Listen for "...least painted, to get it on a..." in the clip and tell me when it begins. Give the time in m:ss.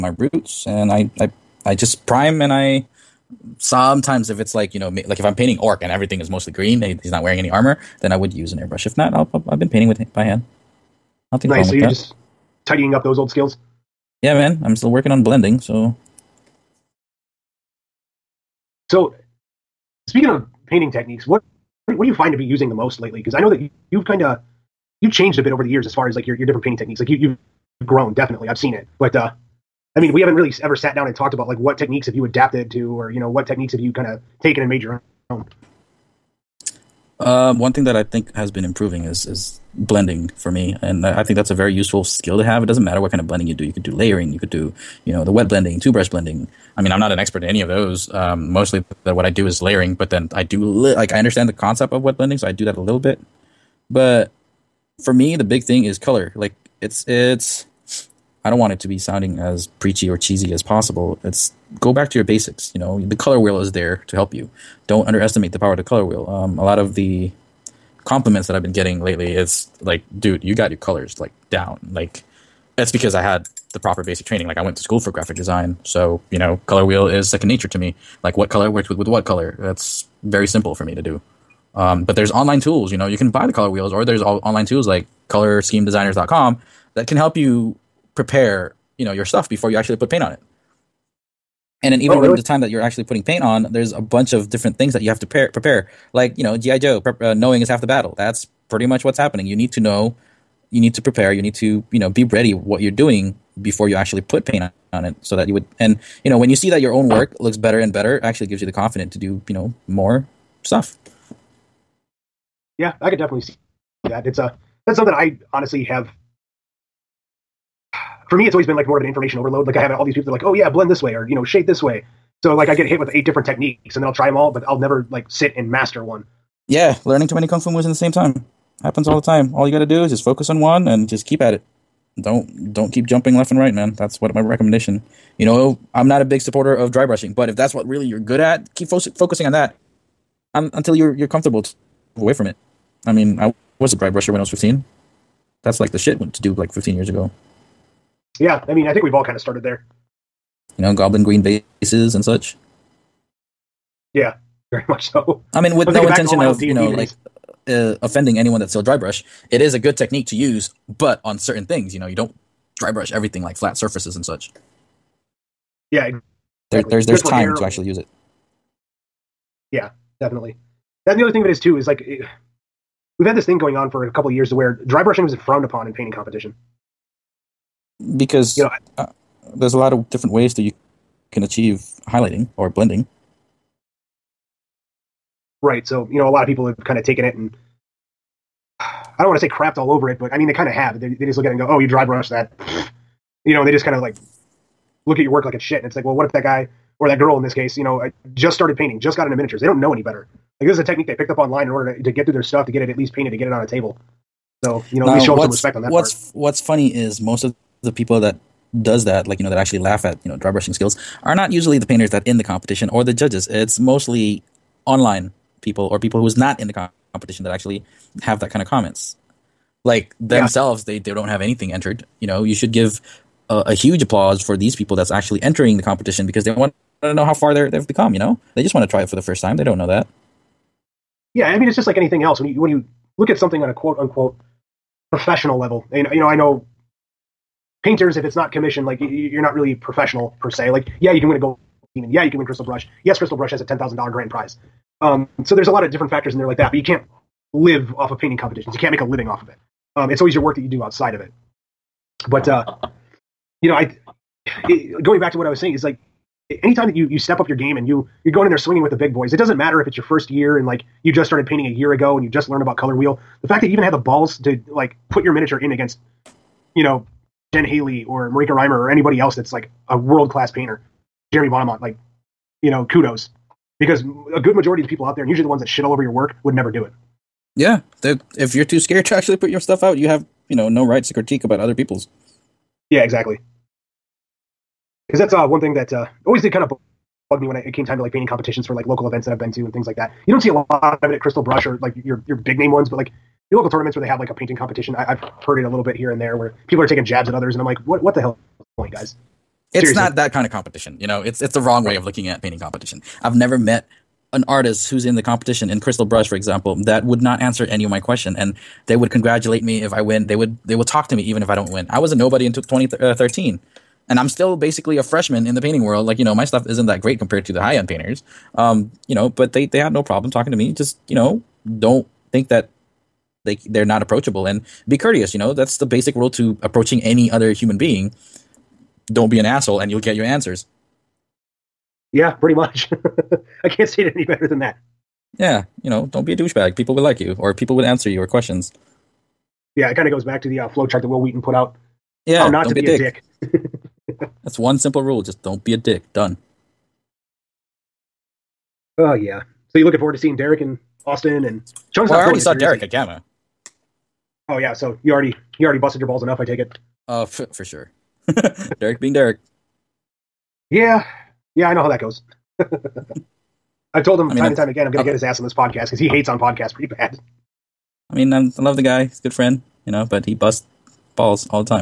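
3:22.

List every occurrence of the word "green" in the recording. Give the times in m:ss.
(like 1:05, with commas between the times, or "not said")
0:06, 2:31.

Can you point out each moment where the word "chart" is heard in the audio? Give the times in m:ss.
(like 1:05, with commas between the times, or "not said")
5:40.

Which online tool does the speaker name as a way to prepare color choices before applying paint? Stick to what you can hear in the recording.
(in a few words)
colorschemedesigners.com.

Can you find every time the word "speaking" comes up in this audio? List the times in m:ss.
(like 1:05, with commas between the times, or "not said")
0:20.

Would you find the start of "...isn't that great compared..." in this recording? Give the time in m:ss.
5:16.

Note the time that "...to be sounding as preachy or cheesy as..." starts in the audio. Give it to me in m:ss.
0:58.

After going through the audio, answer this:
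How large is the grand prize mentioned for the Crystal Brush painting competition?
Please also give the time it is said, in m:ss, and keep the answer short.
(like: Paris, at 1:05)
$10,000, at 4:03.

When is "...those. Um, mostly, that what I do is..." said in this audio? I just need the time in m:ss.
0:47.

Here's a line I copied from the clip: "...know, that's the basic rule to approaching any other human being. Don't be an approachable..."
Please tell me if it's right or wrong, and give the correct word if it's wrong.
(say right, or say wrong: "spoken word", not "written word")
wrong: "asshole", not "approachable".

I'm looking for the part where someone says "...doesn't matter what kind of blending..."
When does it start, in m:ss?
0:42.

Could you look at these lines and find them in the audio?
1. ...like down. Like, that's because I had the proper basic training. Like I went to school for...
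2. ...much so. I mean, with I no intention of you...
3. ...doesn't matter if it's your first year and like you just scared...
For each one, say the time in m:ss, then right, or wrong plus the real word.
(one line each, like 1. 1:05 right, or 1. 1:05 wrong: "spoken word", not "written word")
1. 1:11 right
2. 2:34 right
3. 4:19 wrong: "started", not "scared".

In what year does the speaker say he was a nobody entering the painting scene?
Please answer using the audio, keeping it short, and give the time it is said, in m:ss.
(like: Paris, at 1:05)
2013, at 5:12.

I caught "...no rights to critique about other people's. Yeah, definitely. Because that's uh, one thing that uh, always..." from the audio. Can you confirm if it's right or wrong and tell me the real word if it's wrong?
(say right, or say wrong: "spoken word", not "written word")
wrong: "exactly", not "definitely".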